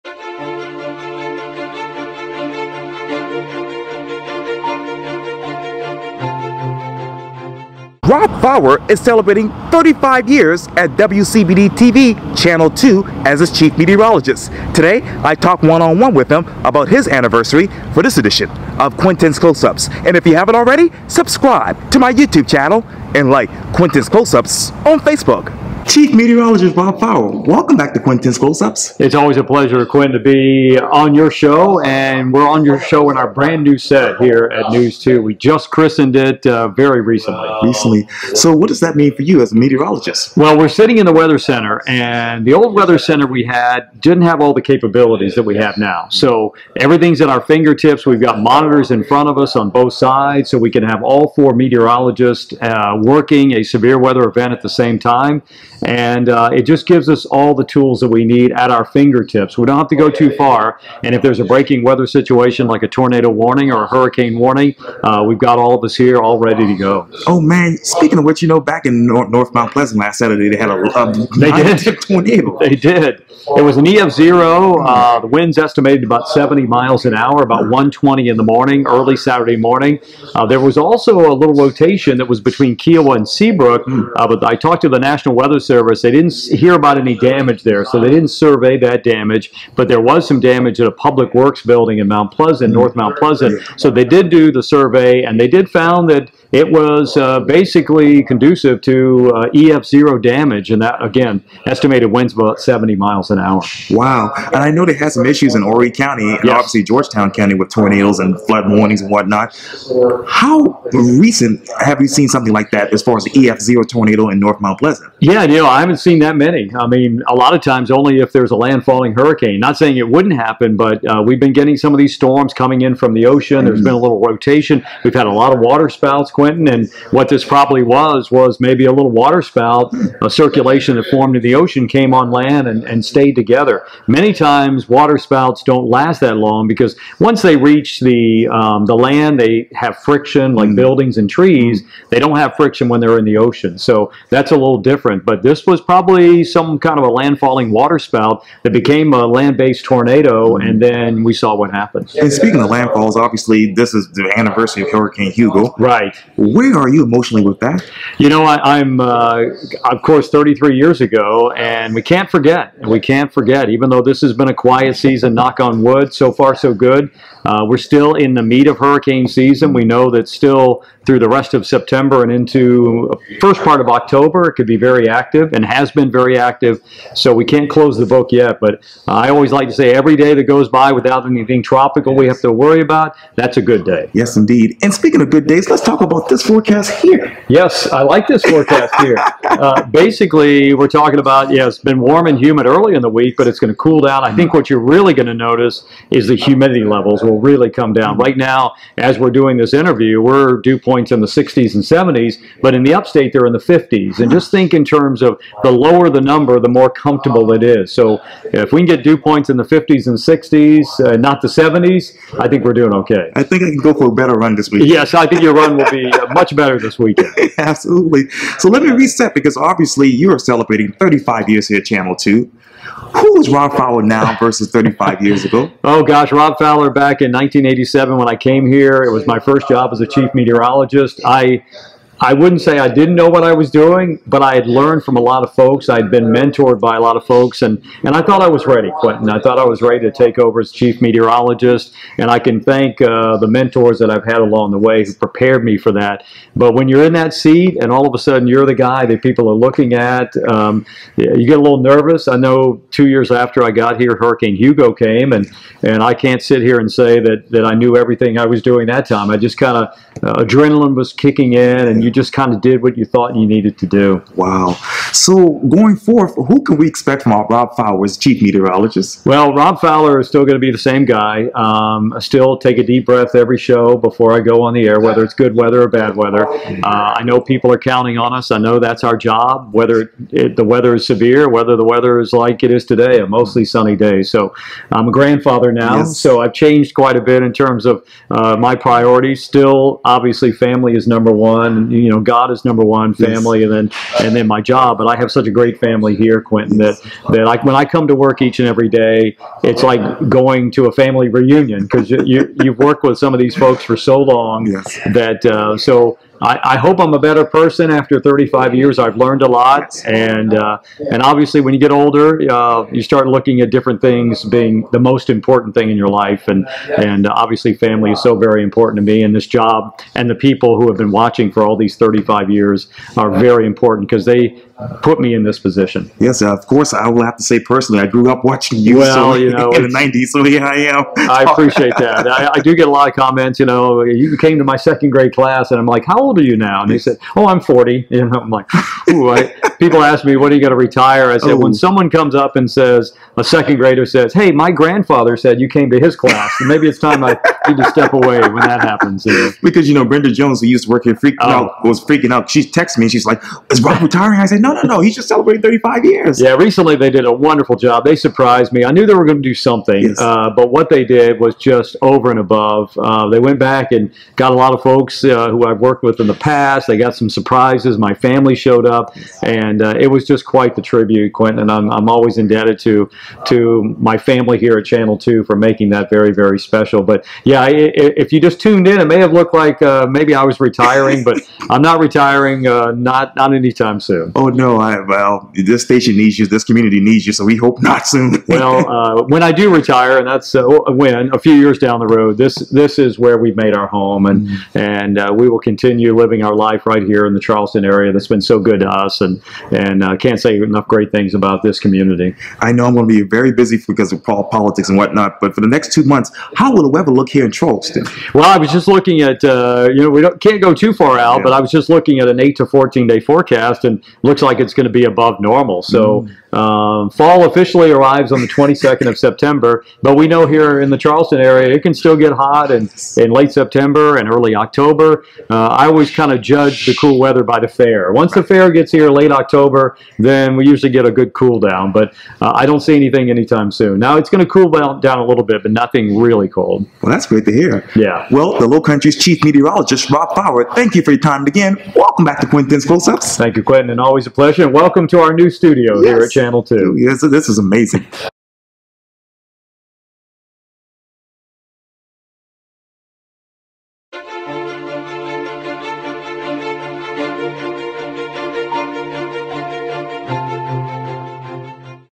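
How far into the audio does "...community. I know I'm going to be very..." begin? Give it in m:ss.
6:41.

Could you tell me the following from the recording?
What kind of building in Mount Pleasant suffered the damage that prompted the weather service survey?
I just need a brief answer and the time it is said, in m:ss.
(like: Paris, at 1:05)
public works building, at 1:30.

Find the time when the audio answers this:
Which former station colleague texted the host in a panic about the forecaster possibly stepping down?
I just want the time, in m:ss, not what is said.
5:50.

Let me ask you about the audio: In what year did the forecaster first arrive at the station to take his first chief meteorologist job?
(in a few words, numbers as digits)
1987.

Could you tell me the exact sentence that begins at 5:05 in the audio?
that uh, so I, I, hope I'm a better person after 35 years.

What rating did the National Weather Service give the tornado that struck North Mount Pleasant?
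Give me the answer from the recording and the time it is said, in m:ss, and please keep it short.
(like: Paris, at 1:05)
EF0, at 1:13.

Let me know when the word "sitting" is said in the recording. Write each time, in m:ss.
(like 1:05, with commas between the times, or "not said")
0:40.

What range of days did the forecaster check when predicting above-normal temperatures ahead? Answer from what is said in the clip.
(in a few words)
8 to 14 day.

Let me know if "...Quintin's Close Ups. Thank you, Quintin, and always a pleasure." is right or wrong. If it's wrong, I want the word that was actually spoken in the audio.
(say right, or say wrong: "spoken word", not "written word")
right.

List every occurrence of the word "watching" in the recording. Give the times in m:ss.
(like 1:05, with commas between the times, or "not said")
5:21, 5:28.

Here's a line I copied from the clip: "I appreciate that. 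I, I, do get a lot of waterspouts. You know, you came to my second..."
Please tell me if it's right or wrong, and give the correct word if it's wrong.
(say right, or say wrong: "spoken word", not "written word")
wrong: "comments", not "waterspouts".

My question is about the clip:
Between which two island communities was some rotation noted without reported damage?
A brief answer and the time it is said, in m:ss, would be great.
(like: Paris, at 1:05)
Kiawah and Seabrook, at 1:22.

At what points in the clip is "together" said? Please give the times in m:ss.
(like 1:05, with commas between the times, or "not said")
2:13.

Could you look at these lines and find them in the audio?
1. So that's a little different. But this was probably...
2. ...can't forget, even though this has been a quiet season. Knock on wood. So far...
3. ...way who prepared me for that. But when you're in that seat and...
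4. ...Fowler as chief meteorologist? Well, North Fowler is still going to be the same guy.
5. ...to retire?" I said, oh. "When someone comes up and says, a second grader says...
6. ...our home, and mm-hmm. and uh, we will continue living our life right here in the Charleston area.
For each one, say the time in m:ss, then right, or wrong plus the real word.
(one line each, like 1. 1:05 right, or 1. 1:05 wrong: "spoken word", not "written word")
1. 2:23 right
2. 2:42 right
3. 4:04 right
4. 4:27 wrong: "Rob", not "North"
5. 5:40 right
6. 6:33 right.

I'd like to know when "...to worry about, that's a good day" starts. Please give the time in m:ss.
3:02.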